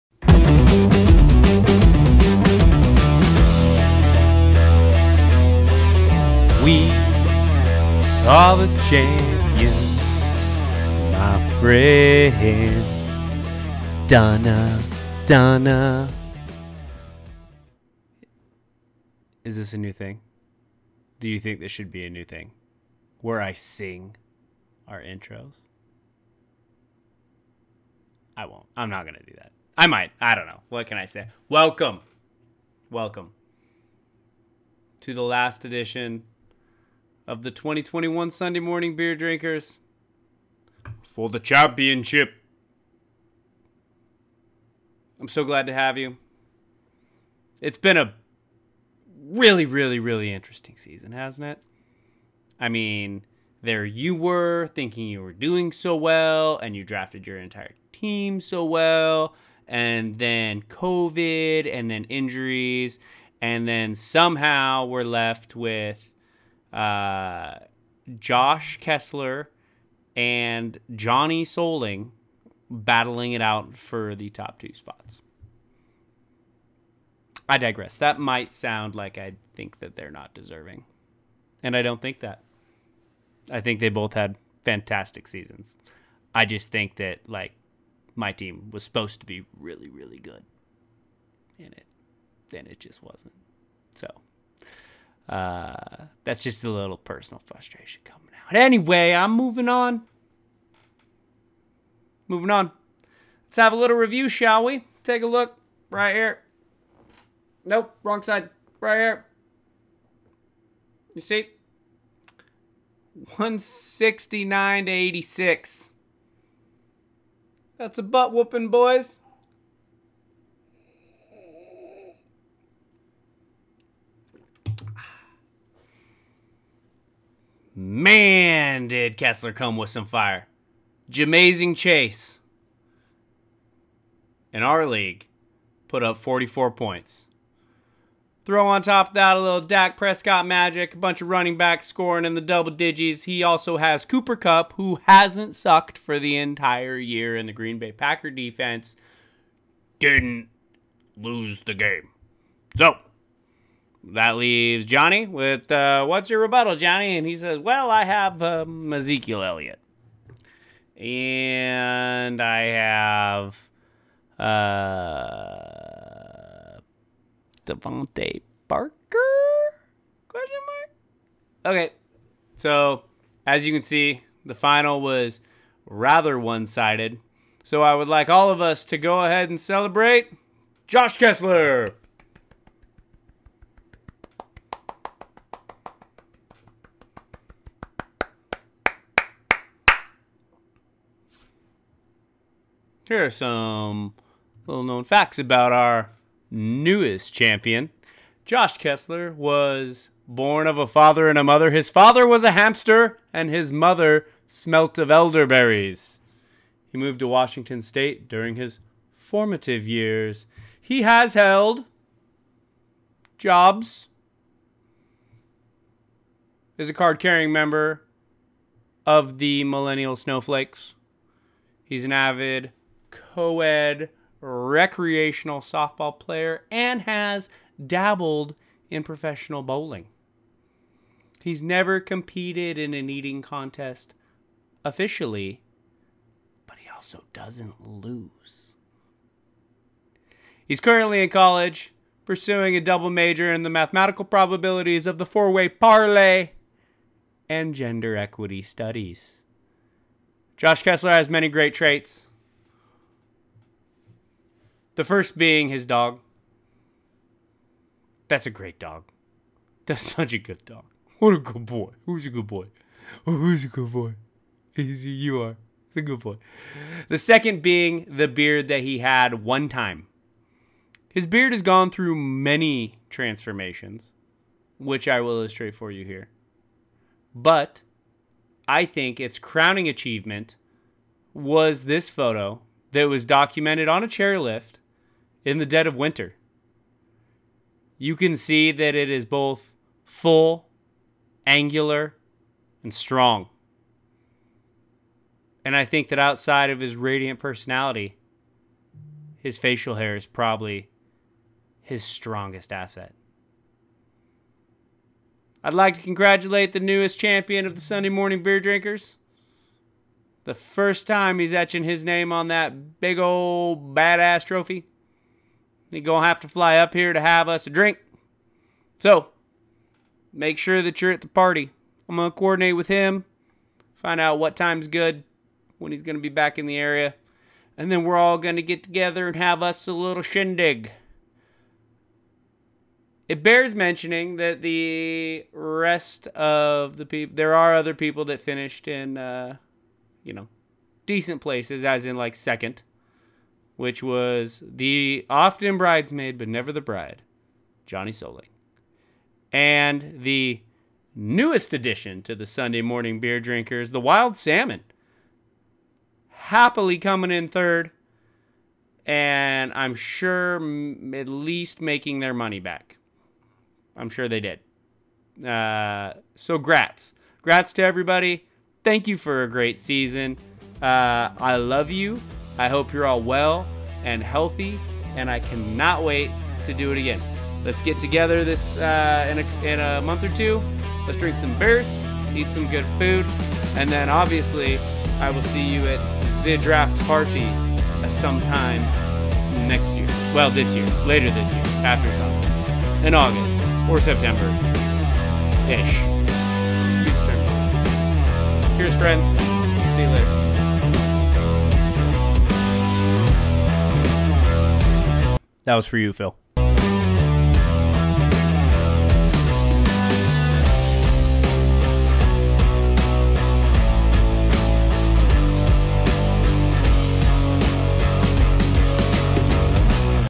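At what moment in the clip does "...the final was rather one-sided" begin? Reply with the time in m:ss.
2:54.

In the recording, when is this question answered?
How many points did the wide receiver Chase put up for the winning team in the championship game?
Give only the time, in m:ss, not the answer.
2:16.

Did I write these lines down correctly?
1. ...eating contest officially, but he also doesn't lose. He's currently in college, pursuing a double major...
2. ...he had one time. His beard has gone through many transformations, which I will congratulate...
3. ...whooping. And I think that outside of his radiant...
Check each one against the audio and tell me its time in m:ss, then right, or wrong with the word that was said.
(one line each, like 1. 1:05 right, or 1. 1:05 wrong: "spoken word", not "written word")
1. 3:53 right
2. 4:28 wrong: "illustrate", not "congratulate"
3. 4:52 wrong: "strong", not "whooping".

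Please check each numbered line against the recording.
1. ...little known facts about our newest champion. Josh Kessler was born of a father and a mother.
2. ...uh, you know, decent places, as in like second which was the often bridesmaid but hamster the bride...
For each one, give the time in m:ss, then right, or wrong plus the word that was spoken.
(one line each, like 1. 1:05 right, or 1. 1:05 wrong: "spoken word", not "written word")
1. 3:14 right
2. 5:39 wrong: "never", not "hamster".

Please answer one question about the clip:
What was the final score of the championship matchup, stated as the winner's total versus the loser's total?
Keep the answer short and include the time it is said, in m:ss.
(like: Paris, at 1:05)
169 to 86, at 1:53.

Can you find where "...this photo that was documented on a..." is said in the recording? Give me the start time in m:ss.
4:41.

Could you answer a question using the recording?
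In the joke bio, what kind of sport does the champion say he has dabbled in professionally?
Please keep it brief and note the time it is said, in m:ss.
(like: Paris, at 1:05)
bowling, at 3:49.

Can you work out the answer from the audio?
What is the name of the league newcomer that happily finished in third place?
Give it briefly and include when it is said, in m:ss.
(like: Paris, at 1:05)
Wild Salmon, at 5:53.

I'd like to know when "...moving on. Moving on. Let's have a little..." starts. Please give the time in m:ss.
1:39.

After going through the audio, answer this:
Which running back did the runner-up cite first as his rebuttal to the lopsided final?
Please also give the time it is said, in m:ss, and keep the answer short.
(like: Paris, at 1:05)
Ezekiel Elliott, at 2:38.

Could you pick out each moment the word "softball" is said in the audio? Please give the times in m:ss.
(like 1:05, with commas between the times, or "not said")
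3:45.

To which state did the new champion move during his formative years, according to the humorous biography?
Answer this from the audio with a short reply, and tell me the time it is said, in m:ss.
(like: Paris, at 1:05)
Washington State, at 3:27.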